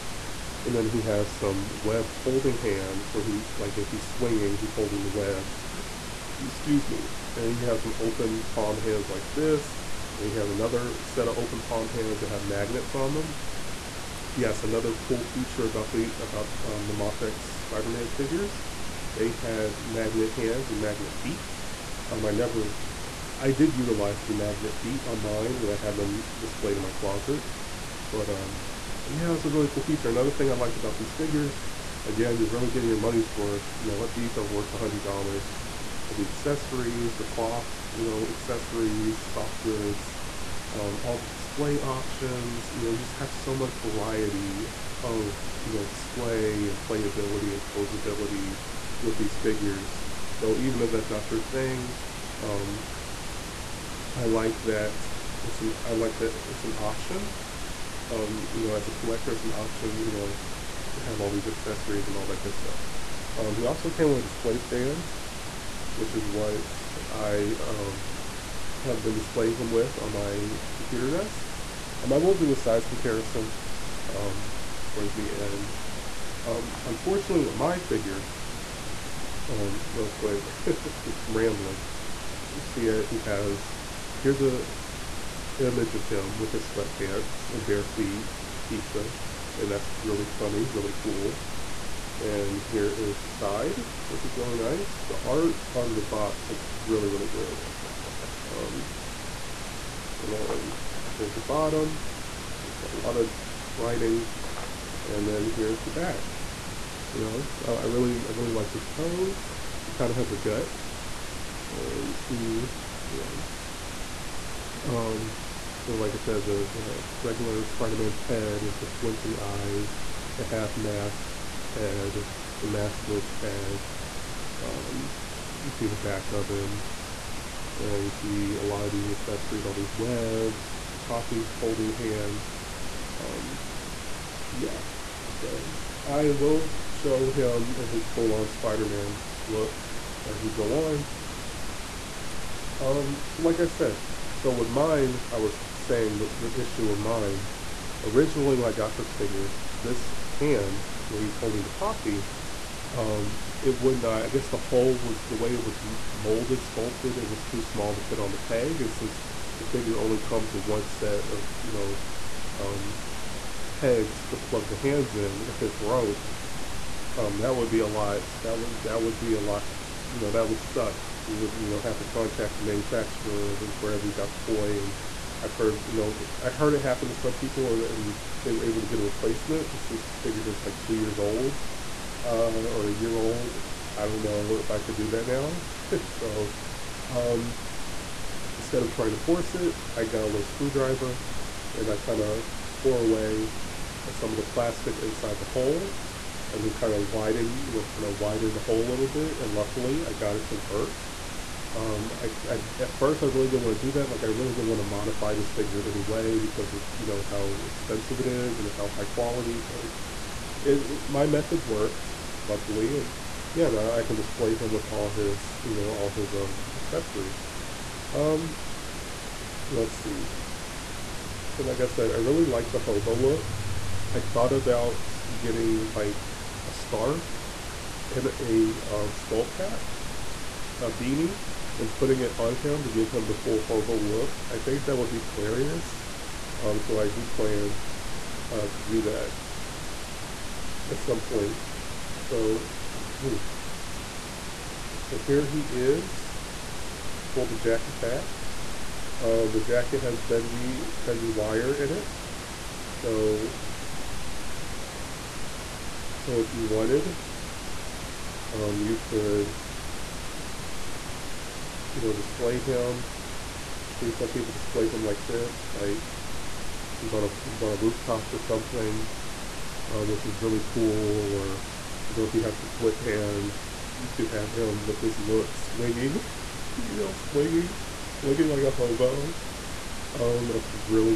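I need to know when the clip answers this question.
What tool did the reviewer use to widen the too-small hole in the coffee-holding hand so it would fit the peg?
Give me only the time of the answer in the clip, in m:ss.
3:10.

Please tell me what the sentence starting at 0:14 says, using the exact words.
Yes, another cool feature about the about um, the Mafex Spider-Man figures, they had magnet hands and magnet feet.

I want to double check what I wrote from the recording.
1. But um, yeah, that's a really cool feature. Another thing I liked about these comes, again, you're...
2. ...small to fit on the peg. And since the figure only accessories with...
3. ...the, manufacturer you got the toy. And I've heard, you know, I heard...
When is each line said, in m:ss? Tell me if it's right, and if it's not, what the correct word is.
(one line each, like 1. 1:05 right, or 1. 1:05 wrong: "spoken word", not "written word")
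1. 0:28 wrong: "figures", not "comes"
2. 2:37 wrong: "comes", not "accessories"
3. 2:53 wrong: "wherever", not "manufacturer".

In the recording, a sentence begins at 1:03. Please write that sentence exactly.
Um, he also came with a display stand, which is what I um, have been displaying him with on my computer desk.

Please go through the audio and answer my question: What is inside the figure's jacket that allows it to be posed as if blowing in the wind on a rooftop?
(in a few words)
bendy wire.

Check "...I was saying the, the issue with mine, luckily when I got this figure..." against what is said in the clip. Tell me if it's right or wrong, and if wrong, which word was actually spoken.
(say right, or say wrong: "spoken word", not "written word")
wrong: "originally", not "luckily".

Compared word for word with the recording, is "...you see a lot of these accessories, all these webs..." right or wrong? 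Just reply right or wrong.
right.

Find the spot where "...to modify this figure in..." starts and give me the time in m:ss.
3:24.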